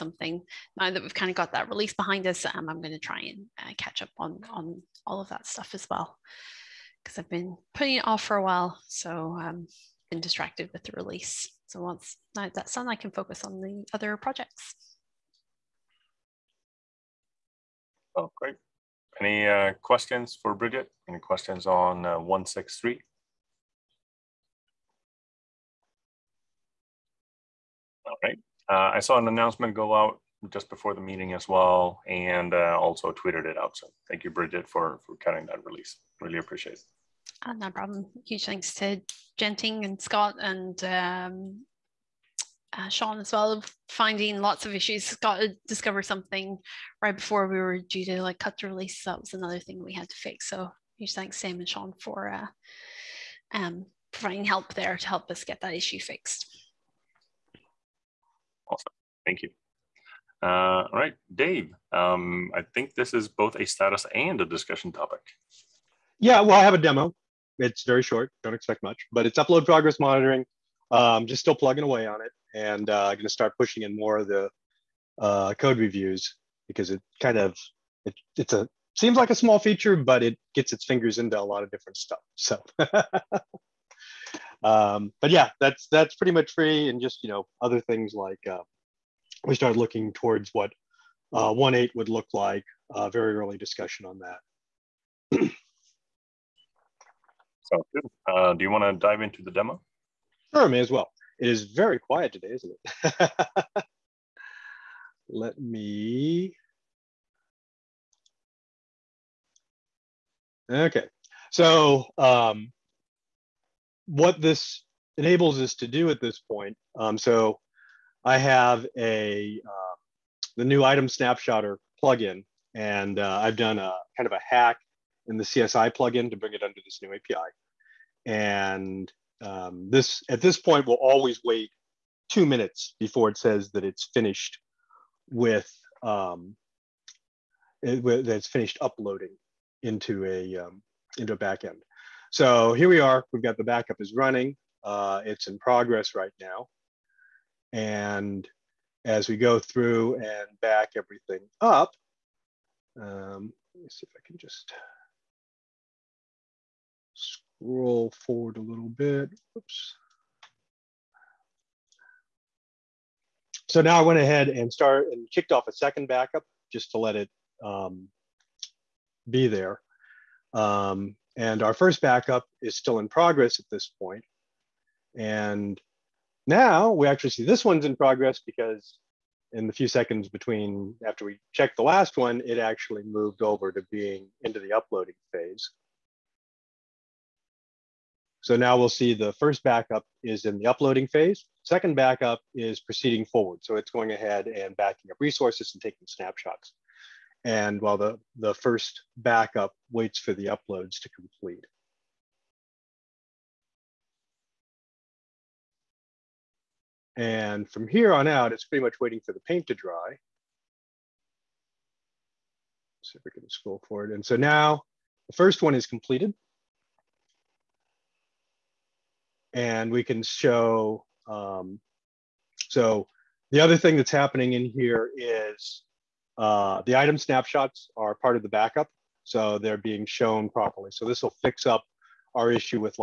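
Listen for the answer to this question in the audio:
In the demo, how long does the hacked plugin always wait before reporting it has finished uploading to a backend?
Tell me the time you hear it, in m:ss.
2:12.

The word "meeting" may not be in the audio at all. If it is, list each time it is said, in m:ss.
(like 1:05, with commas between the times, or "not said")
0:30.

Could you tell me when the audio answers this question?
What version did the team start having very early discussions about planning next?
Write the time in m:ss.
1:31.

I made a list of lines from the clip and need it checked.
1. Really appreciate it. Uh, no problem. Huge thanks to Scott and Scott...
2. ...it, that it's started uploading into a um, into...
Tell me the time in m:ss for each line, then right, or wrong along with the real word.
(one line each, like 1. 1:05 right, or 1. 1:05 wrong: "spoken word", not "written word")
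1. 0:36 wrong: "Genting", not "Scott"
2. 2:17 wrong: "finished", not "started".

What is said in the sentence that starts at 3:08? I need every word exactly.
So now we'll see the first backup is in the uploading phase.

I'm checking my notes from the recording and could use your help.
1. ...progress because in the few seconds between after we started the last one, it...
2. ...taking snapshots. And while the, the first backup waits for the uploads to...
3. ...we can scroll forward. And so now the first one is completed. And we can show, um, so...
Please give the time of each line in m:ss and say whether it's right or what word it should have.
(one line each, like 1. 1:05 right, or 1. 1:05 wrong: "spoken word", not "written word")
1. 2:57 wrong: "checked", not "started"
2. 3:15 right
3. 3:33 right.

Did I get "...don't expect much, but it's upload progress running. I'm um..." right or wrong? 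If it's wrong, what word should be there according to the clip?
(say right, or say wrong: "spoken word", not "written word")
wrong: "monitoring", not "running".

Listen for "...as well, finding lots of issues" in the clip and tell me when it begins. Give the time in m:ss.
0:43.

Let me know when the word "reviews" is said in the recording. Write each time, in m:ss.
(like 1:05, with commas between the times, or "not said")
1:15.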